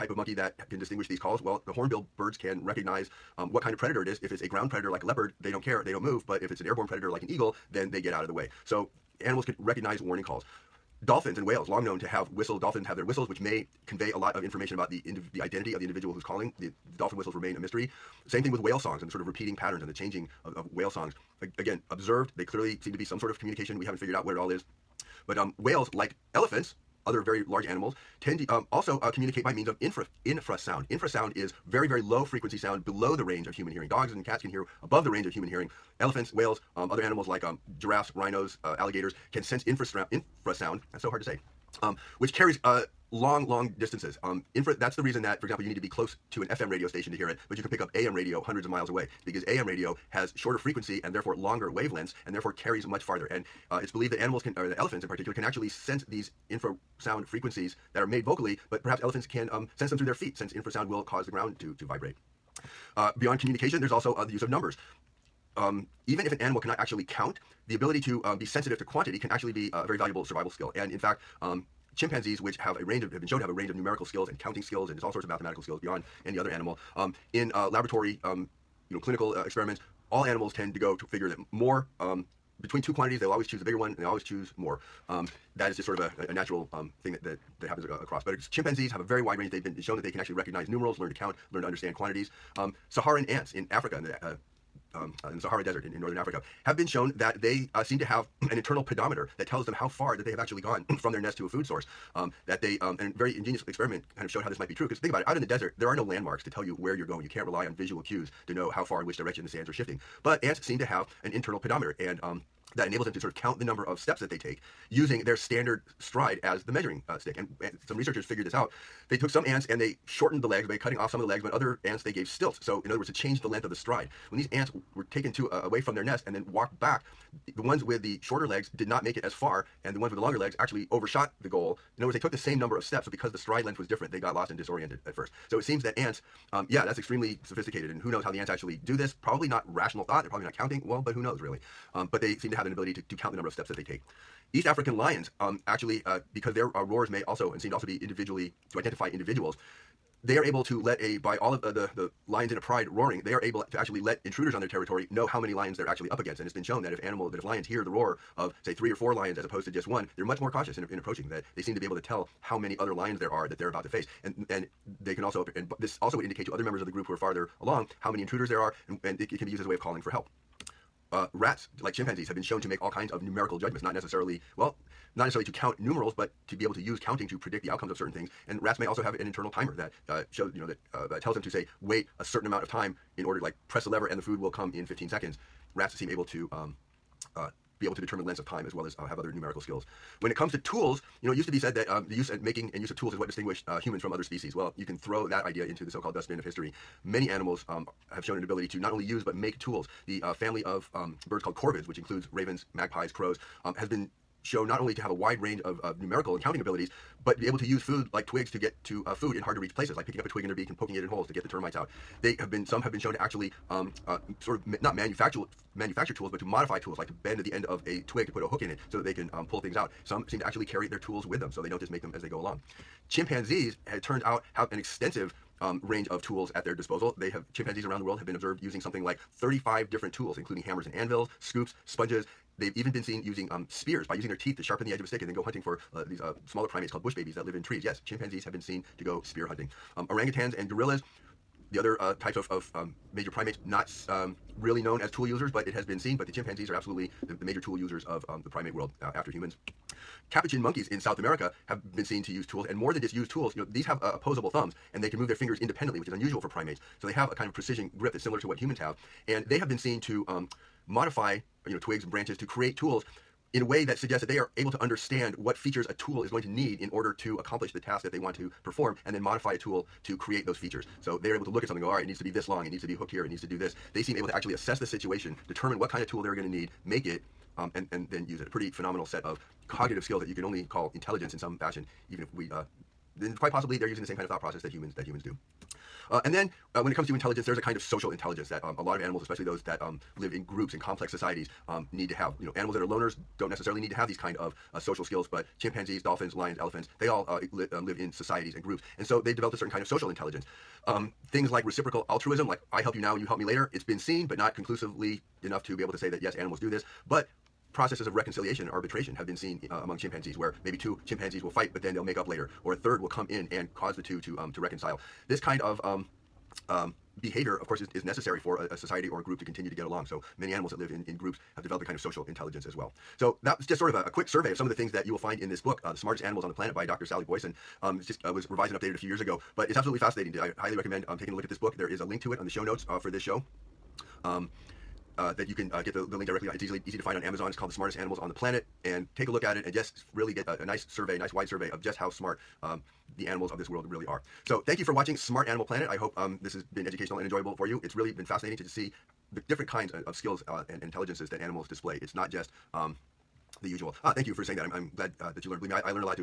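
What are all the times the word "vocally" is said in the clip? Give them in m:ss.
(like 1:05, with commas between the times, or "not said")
0:58.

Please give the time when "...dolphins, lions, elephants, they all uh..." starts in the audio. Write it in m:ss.
4:56.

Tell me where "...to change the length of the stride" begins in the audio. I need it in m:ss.
2:03.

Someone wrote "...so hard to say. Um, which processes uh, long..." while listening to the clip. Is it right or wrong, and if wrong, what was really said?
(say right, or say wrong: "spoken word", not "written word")
wrong: "carries", not "processes".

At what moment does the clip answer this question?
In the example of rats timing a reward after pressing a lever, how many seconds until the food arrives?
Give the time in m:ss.
3:04.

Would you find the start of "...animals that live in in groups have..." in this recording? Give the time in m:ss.
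5:20.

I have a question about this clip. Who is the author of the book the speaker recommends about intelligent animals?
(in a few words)
Dr. Sally Boysen.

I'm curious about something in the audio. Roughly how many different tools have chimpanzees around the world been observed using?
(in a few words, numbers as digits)
35.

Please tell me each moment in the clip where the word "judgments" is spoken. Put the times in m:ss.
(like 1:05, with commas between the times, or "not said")
2:53.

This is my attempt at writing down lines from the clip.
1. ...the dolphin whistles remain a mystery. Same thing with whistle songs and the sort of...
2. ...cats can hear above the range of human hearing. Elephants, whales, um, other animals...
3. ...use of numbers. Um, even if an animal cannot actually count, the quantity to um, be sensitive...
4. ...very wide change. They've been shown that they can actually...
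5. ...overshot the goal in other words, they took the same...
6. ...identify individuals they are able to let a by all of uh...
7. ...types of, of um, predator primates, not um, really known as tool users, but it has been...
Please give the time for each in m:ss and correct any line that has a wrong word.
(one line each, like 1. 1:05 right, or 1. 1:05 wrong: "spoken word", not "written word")
1. 0:16 wrong: "whale", not "whistle"
2. 0:34 right
3. 1:04 wrong: "ability", not "quantity"
4. 1:29 wrong: "range", not "change"
5. 2:10 right
6. 2:28 right
7. 4:02 wrong: "major", not "predator".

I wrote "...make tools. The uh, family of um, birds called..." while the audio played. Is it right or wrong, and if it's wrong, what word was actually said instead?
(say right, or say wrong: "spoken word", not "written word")
right.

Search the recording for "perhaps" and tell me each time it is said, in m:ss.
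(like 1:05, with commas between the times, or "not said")
0:58.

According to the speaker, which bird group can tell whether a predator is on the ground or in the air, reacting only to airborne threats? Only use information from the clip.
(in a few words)
Hornbill birds.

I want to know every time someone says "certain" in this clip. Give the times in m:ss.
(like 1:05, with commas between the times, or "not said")
2:57, 3:02, 4:59.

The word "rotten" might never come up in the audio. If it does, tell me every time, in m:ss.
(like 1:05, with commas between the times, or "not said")
not said.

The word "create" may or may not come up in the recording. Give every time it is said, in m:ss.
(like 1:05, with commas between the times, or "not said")
4:22, 4:30.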